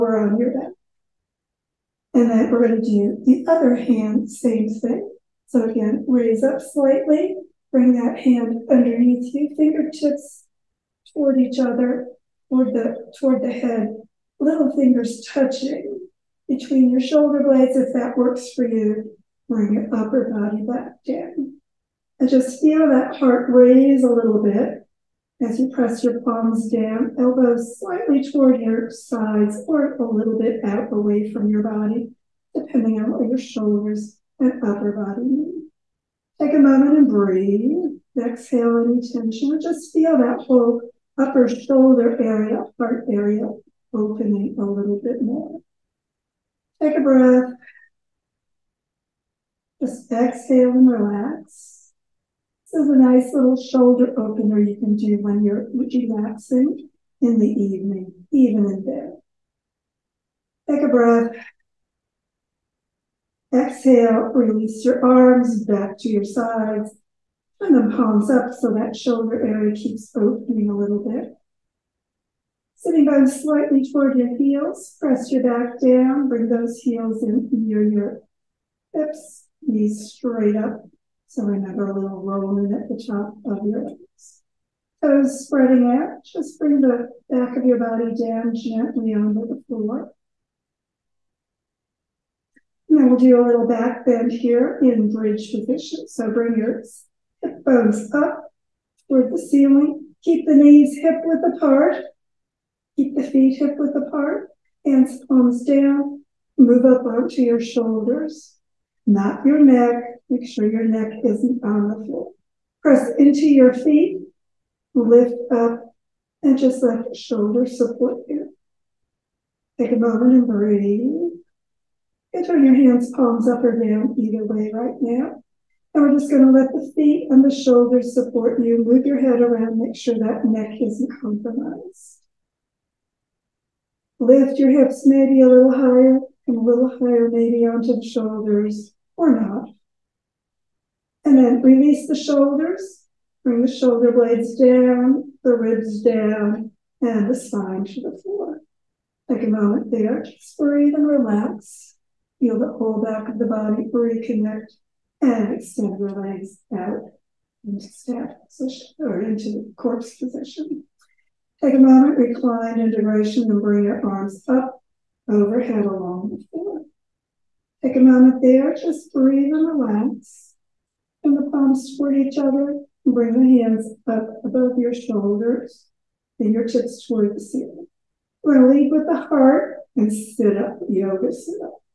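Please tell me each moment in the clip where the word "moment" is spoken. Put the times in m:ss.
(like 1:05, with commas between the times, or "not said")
0:36, 1:59, 2:29, 2:41, 2:47.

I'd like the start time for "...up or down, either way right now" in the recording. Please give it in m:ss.
2:03.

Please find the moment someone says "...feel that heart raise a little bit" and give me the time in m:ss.
0:22.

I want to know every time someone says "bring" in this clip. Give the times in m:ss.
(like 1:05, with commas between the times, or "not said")
0:07, 0:19, 1:16, 1:26, 1:36, 2:23, 2:43, 2:53.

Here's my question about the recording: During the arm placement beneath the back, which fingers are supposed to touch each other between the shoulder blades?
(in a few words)
little fingers.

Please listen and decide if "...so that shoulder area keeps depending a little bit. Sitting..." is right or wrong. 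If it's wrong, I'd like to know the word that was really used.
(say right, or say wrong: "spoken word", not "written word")
wrong: "opening", not "depending".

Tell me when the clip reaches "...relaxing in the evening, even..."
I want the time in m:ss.
0:55.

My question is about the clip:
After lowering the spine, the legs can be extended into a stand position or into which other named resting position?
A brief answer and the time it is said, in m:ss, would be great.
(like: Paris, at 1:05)
corpse position, at 2:39.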